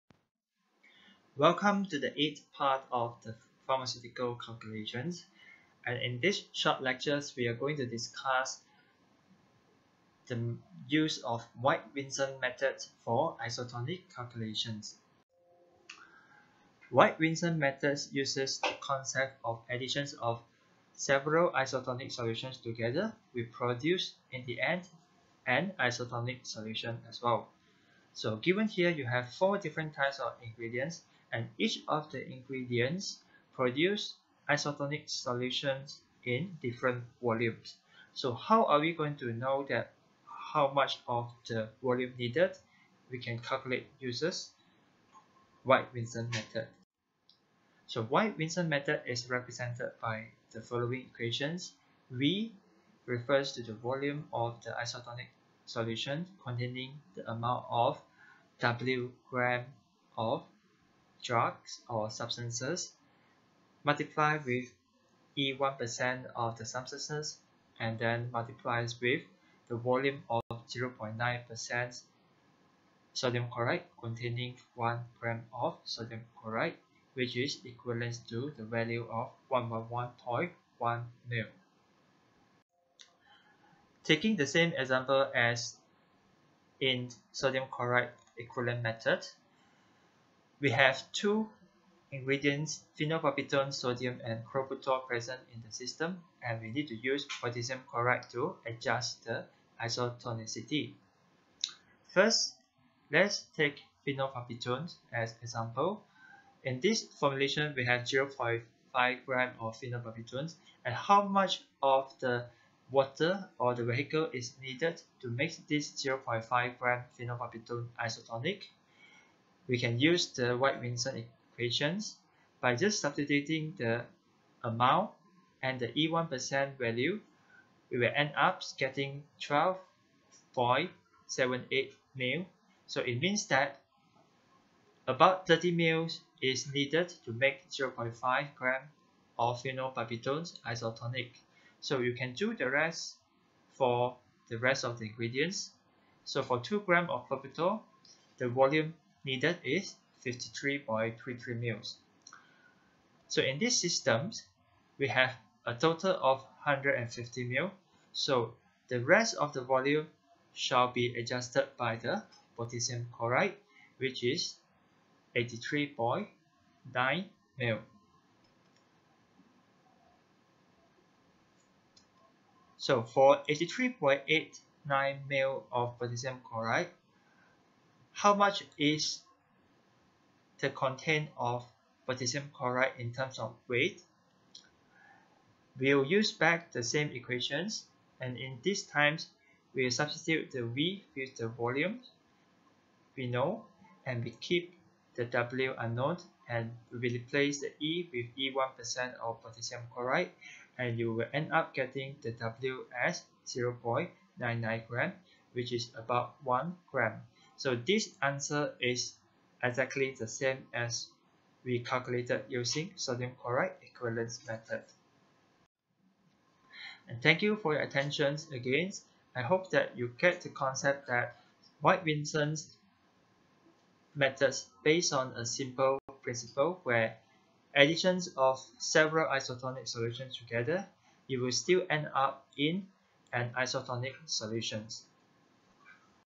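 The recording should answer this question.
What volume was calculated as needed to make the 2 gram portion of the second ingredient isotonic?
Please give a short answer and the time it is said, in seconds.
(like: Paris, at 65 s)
53.33 mL, at 150 s.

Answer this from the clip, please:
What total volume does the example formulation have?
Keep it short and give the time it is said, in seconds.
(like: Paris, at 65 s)
150 mL, at 156 s.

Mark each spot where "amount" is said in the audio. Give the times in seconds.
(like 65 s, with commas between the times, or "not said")
57 s, 124 s.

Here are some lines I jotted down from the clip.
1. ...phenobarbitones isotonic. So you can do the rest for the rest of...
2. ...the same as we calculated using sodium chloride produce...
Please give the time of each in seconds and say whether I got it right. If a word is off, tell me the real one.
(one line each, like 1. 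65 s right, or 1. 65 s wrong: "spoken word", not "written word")
1. 139 s right
2. 210 s wrong: "equivalence", not "produce".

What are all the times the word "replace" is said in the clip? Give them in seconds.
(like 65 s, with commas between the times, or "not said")
197 s.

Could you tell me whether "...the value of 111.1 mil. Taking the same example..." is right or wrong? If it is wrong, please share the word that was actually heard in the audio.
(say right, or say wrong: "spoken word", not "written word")
right.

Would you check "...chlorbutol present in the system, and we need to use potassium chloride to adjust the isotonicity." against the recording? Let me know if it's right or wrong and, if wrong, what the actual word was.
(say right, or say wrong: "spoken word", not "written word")
right.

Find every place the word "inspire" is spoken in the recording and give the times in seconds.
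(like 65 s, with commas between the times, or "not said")
not said.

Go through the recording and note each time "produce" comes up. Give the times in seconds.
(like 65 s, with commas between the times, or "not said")
23 s, 33 s.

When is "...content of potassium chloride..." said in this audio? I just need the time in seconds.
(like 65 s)
180 s.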